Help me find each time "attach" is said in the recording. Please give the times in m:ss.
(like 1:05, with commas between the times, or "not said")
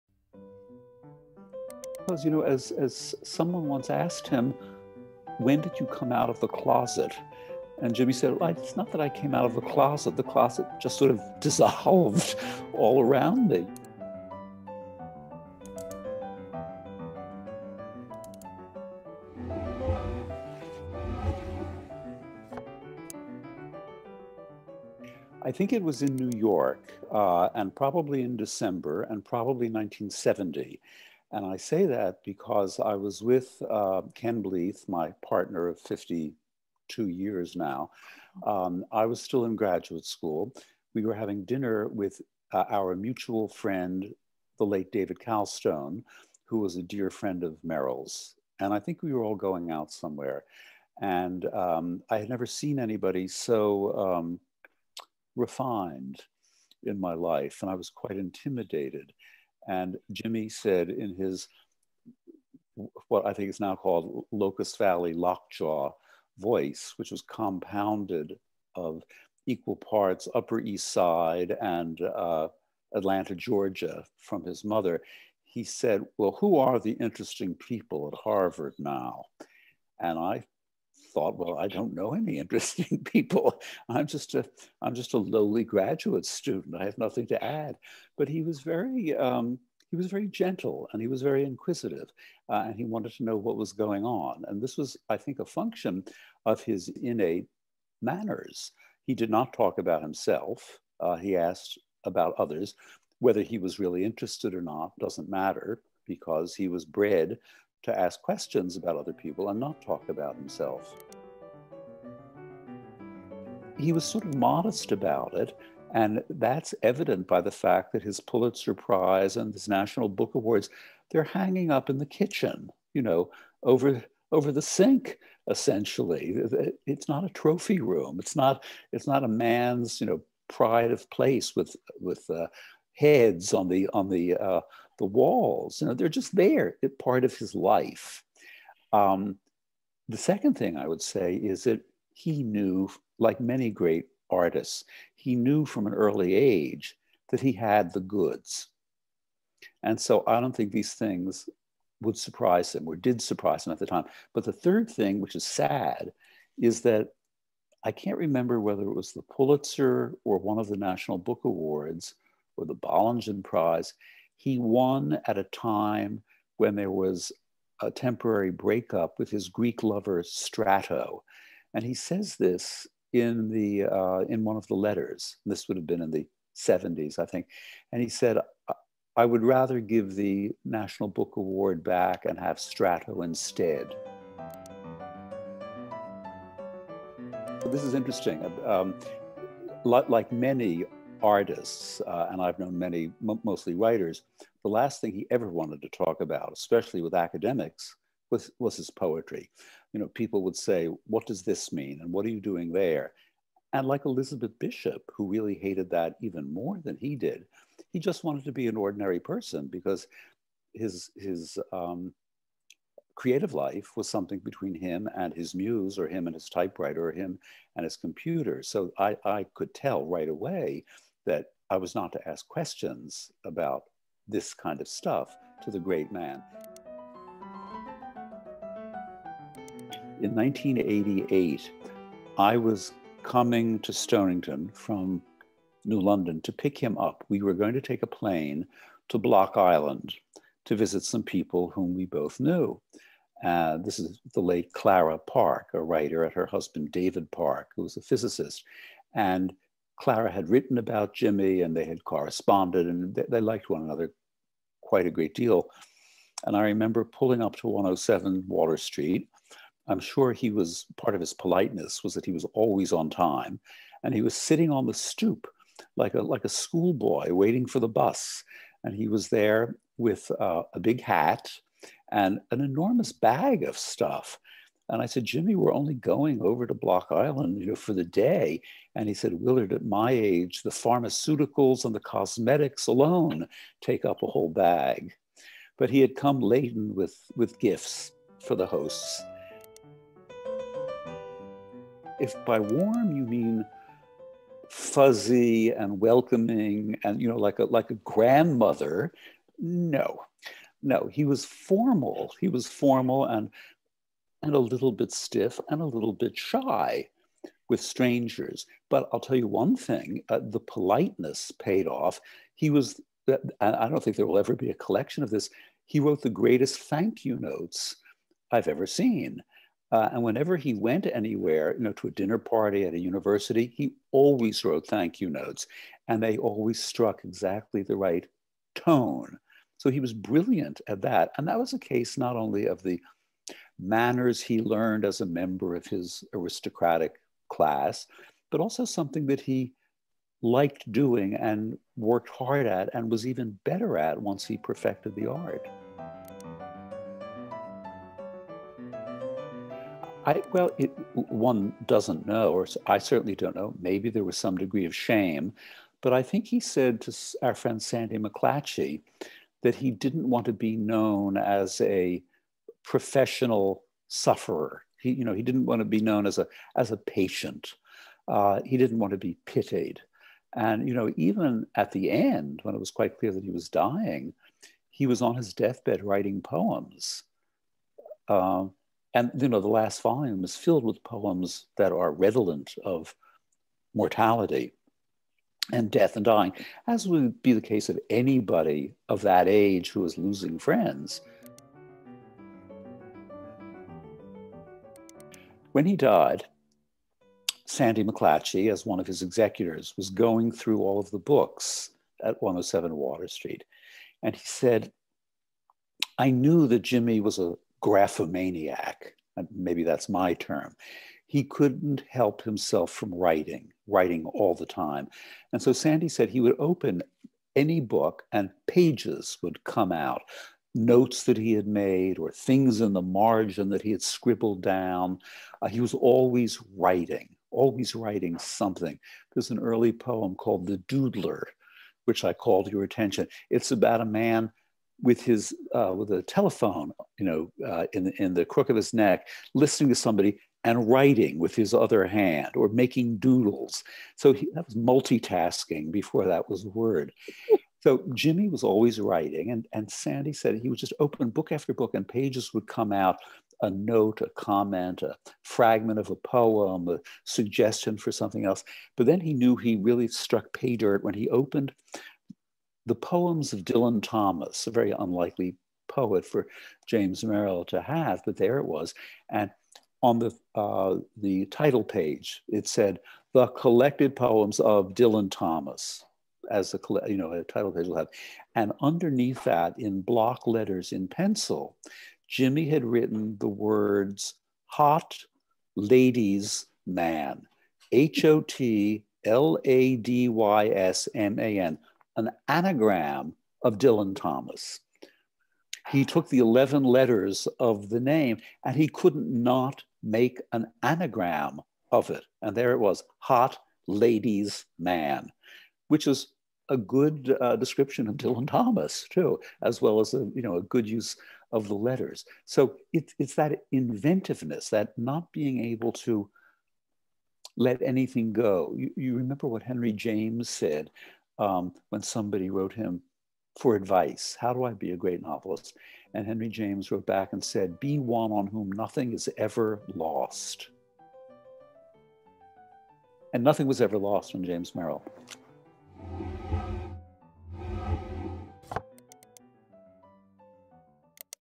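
not said.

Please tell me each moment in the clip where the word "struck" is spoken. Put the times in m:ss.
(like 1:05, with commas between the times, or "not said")
5:26, 7:40.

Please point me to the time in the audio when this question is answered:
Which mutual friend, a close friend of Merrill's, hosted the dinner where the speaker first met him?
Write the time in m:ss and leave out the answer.
0:44.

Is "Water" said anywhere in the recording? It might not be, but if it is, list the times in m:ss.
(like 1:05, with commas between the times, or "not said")
4:18, 6:42.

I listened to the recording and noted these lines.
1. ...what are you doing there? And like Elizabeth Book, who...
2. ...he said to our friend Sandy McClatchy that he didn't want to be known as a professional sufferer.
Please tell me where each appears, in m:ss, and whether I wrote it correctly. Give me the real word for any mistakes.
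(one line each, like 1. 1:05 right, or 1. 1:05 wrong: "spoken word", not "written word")
1. 3:22 wrong: "Bishop", not "Book"
2. 5:56 right.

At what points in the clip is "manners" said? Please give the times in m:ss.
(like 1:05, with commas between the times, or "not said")
1:38, 5:33.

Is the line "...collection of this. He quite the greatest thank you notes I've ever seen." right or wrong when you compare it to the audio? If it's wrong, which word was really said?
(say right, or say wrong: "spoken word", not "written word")
wrong: "wrote", not "quite".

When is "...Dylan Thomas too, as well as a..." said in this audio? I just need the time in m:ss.
8:28.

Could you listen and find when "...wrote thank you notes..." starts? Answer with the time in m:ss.
5:24.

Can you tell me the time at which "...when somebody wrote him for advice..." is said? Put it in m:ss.
8:41.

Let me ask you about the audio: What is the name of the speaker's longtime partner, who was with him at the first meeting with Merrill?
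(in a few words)
Ken Bleeth.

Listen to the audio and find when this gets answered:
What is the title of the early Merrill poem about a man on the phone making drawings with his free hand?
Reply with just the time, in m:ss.
7:10.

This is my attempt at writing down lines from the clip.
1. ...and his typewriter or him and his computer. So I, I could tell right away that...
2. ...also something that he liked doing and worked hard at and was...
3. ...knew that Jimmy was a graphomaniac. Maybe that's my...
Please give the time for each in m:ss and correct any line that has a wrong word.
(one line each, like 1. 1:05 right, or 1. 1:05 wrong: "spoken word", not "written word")
1. 3:36 right
2. 5:38 right
3. 6:46 right.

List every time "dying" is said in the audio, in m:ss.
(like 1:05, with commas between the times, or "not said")
6:13, 6:26.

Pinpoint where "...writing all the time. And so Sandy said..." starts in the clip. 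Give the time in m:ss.
6:53.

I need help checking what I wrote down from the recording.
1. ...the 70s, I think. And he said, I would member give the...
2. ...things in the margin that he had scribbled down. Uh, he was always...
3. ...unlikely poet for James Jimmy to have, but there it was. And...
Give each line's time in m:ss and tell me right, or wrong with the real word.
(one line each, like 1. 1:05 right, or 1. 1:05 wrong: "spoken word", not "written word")
1. 2:56 wrong: "rather", not "member"
2. 7:02 right
3. 7:44 wrong: "Merrill", not "Jimmy".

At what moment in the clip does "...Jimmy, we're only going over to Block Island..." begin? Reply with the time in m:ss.
4:35.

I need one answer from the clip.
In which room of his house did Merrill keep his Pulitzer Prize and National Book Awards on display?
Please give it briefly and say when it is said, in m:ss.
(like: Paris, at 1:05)
the kitchen, at 2:02.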